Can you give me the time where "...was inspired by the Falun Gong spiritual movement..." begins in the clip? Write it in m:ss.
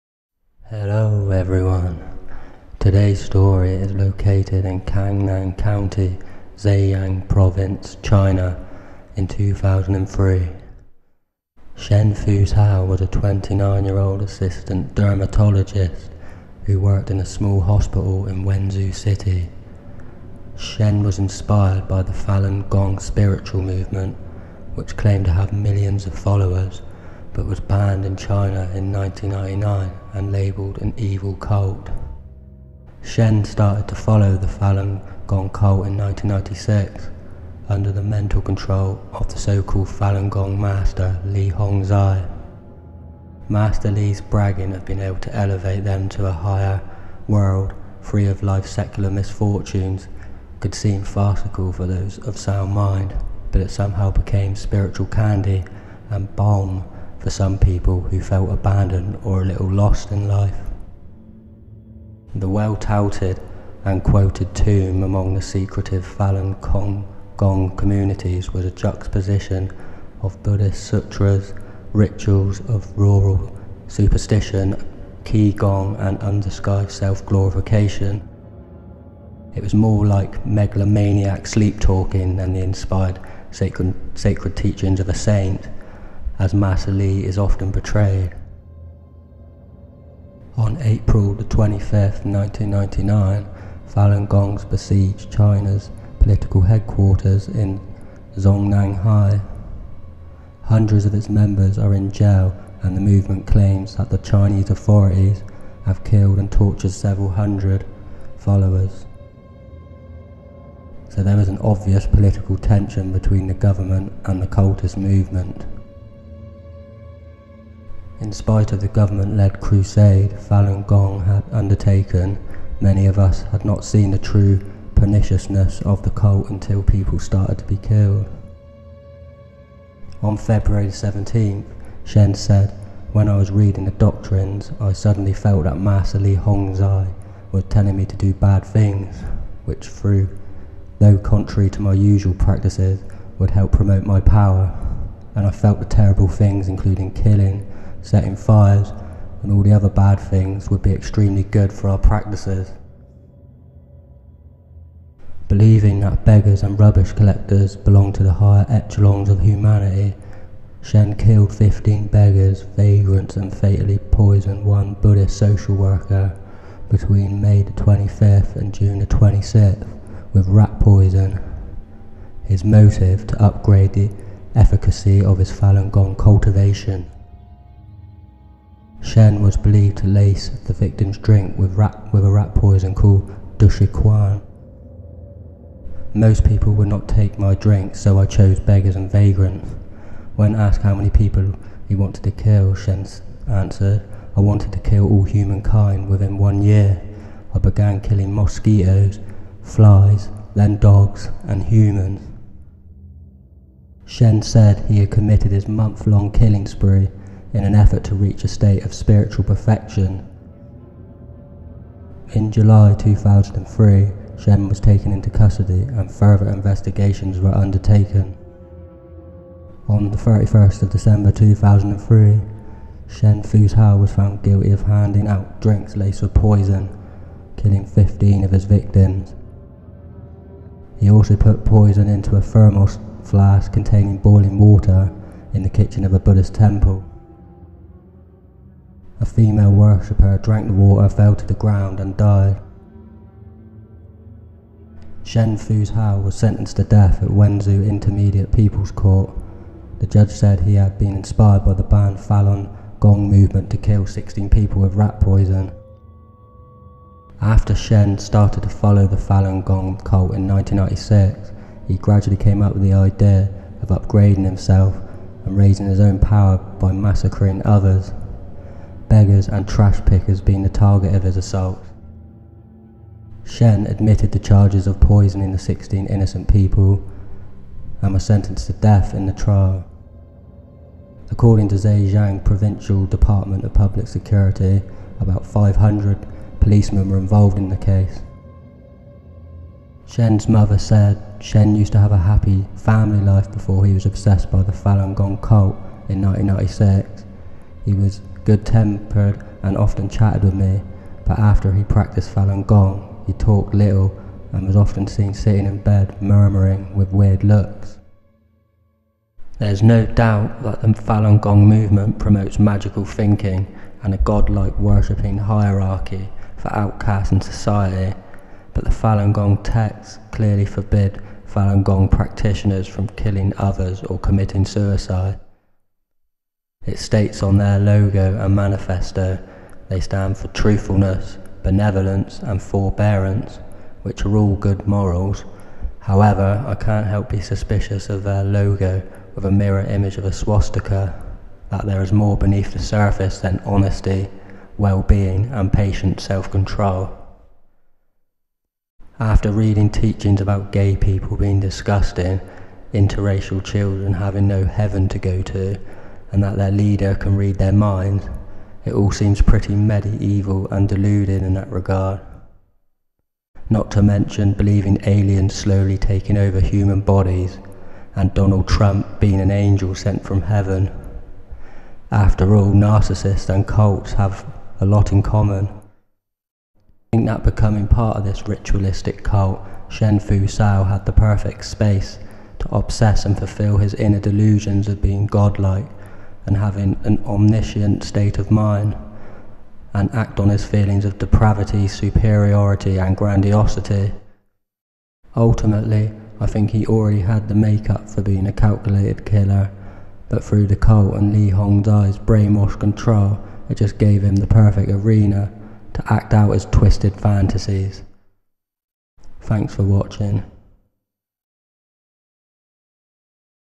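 0:21.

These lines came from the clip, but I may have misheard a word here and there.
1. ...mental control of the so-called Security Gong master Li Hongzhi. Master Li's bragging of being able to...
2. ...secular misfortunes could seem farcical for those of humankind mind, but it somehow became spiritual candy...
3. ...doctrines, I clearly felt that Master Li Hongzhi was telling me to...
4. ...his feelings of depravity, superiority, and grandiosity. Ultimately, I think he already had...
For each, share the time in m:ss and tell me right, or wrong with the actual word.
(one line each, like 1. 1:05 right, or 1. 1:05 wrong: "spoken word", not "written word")
1. 0:38 wrong: "Falun", not "Security"
2. 0:48 wrong: "sound", not "humankind"
3. 2:13 wrong: "suddenly", not "clearly"
4. 6:30 right.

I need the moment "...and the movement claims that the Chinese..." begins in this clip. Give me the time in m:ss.
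1:42.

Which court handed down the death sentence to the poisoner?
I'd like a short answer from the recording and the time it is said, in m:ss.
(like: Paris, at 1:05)
Wenzhou Intermediate People's Court, at 4:07.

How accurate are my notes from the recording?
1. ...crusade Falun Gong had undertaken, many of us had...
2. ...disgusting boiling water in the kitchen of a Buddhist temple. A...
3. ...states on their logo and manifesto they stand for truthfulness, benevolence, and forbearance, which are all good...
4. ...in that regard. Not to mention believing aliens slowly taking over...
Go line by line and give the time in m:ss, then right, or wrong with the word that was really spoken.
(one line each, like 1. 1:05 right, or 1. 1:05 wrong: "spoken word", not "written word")
1. 1:59 right
2. 3:53 wrong: "containing", not "disgusting"
3. 5:26 right
4. 6:01 right.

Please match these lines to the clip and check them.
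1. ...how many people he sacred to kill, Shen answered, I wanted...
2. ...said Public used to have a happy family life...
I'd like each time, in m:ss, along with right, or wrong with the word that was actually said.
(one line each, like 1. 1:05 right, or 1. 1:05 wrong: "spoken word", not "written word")
1. 3:10 wrong: "wanted", not "sacred"
2. 4:50 wrong: "Shen", not "Public".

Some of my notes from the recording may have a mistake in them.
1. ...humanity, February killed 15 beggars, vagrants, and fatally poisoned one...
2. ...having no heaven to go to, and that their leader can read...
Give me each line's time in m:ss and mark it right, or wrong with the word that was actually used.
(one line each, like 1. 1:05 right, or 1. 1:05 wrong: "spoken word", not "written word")
1. 2:39 wrong: "Shen", not "February"
2. 5:54 right.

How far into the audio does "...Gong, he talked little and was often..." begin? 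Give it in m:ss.
5:02.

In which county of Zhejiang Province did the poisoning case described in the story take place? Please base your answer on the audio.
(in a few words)
Cangnan County.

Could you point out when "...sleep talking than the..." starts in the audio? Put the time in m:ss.
1:21.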